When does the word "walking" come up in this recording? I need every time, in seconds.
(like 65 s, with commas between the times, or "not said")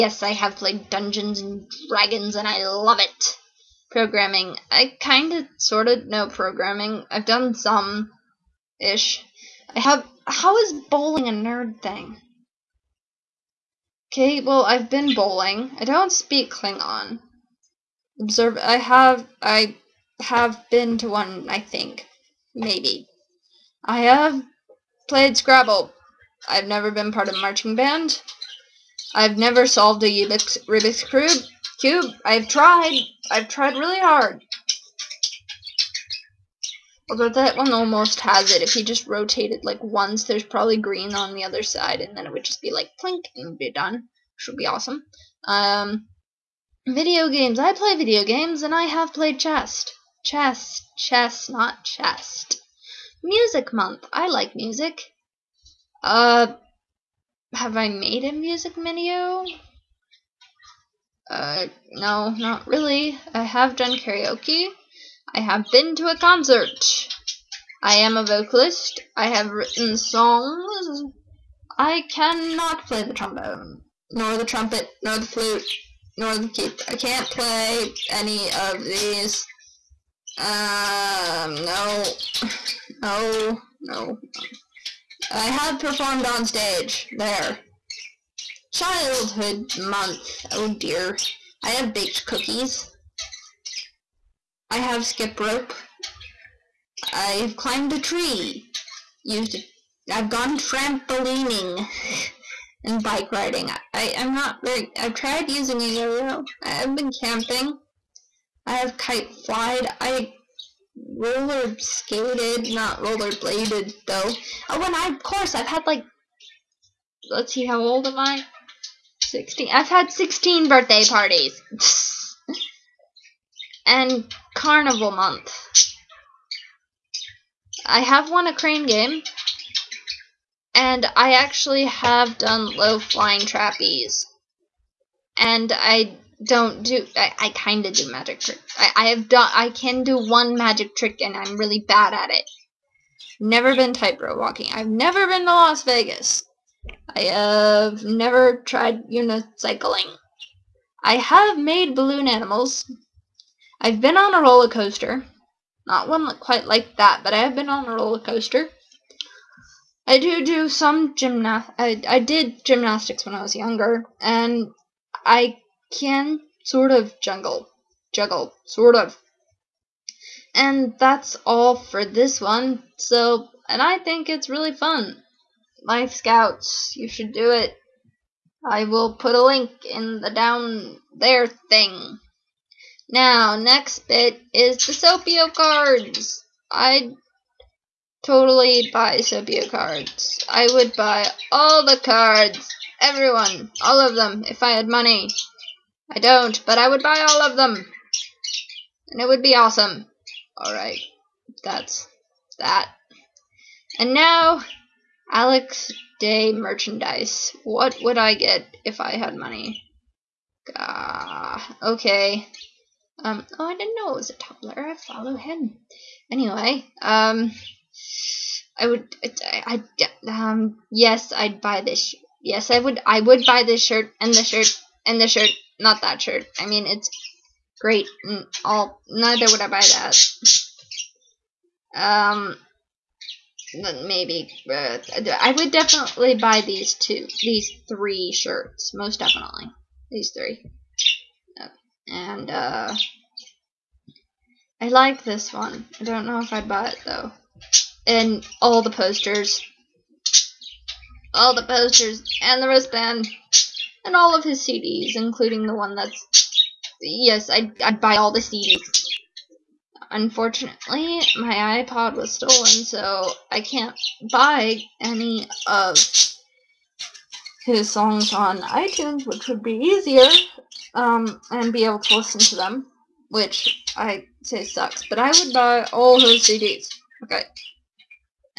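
144 s.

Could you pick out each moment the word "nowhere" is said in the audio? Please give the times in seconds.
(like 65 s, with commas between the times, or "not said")
not said.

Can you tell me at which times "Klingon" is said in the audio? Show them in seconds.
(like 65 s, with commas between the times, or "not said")
16 s.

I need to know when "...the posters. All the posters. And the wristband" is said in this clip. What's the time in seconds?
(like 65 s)
248 s.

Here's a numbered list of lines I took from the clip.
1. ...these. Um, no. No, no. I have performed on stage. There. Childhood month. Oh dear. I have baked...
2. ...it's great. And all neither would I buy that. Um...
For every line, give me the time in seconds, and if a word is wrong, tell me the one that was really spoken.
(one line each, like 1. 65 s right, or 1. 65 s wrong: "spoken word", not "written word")
1. 78 s right
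2. 226 s right.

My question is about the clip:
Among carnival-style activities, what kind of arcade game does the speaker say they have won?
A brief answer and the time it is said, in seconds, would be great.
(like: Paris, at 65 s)
Crane game, at 128 s.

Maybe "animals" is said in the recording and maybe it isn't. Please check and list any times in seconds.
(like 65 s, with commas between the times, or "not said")
152 s.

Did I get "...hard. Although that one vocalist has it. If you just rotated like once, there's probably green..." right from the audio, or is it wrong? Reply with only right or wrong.
wrong.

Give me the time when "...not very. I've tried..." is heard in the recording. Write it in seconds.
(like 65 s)
104 s.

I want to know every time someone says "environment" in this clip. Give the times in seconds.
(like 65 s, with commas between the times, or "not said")
not said.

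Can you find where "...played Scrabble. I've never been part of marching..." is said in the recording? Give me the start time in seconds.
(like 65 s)
25 s.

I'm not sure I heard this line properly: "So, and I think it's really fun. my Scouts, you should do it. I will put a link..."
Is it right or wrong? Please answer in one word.
right.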